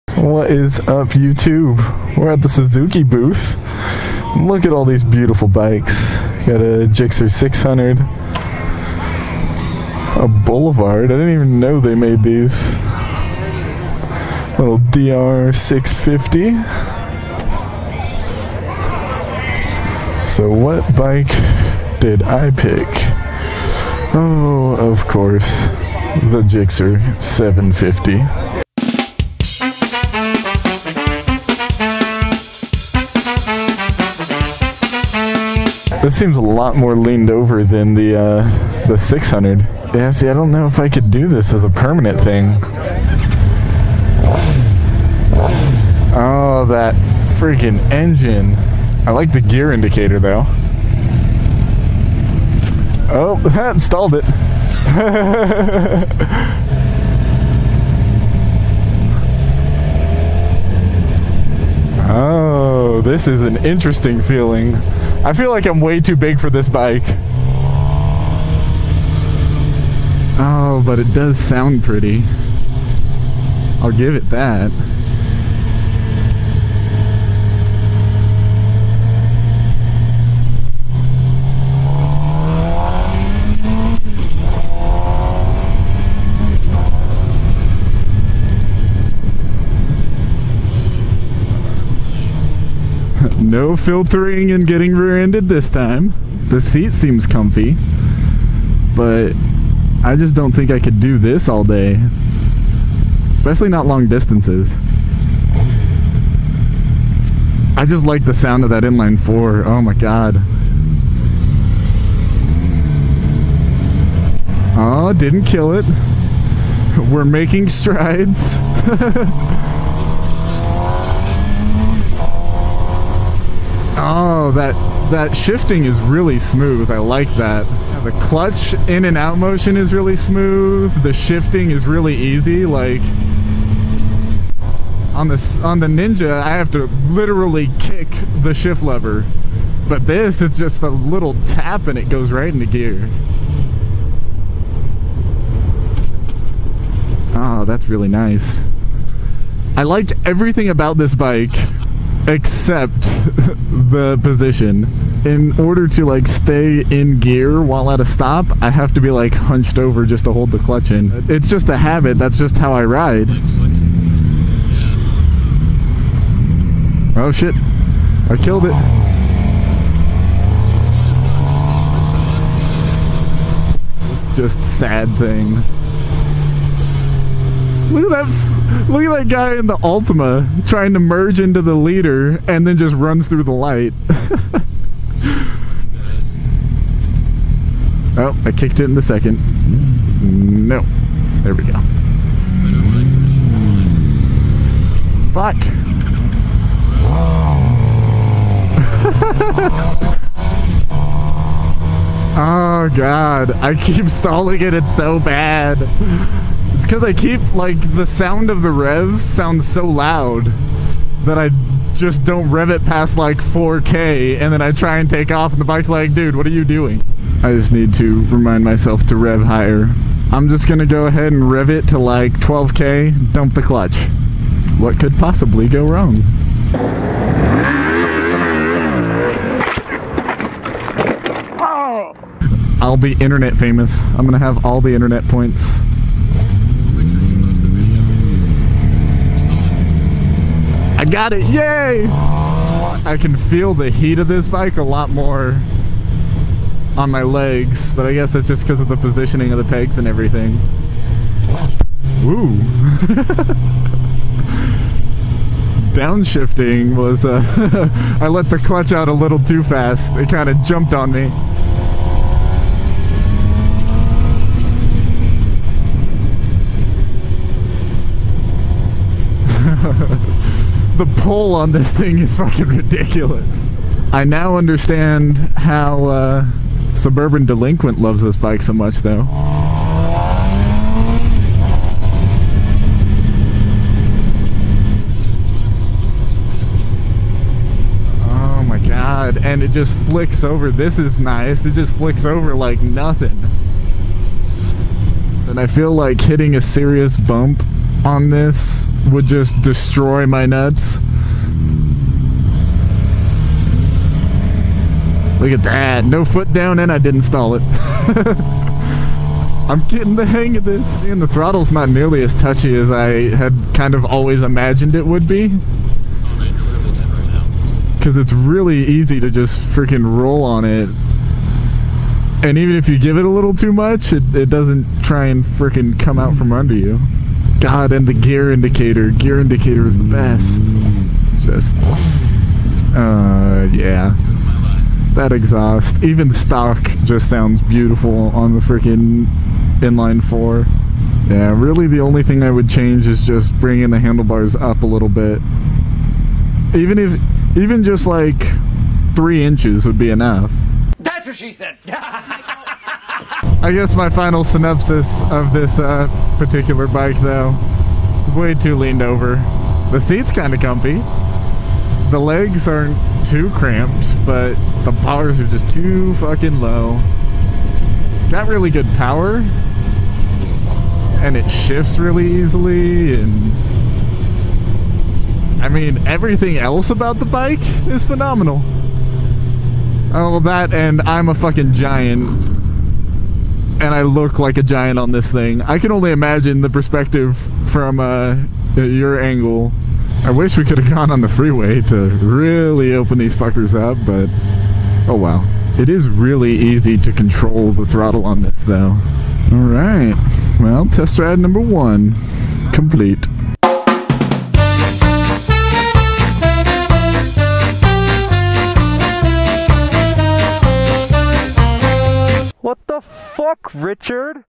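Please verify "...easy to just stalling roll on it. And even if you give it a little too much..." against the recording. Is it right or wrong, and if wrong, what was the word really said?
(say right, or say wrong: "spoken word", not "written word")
wrong: "freaking", not "stalling".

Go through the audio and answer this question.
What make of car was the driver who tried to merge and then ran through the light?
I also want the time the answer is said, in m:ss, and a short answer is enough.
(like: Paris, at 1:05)
Altima, at 2:59.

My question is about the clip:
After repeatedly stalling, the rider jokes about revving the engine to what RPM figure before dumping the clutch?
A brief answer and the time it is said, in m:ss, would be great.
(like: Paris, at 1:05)
12K, at 3:42.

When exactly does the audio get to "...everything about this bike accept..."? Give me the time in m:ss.
2:30.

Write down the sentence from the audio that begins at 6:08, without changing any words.
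It's got really good power, and it shifts really easily, and I mean, everything else about the bike is phenomenal.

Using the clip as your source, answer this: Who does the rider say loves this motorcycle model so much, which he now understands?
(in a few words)
Suburban Delinquent.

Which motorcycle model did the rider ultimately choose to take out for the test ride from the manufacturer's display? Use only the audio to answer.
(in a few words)
Gixxer 750.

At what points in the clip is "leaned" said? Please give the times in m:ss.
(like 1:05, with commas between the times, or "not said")
0:36, 5:58.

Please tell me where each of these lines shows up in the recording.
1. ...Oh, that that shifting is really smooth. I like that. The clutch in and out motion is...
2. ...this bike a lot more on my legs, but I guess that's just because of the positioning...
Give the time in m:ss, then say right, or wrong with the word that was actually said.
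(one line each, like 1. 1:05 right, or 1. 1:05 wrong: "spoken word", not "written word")
1. 2:03 right
2. 4:04 right.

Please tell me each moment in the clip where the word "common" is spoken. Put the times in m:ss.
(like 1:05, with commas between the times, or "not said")
not said.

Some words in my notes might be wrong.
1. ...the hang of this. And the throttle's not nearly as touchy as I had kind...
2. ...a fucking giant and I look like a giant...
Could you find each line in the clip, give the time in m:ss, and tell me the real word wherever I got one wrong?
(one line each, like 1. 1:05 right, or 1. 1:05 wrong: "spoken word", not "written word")
1. 5:10 right
2. 6:21 right.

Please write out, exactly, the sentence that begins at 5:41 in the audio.
Yeah, really the only thing I would change is just bringing the handlebars up a little bit.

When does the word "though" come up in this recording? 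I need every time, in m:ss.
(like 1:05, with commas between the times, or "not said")
0:50, 4:38, 5:57, 6:38.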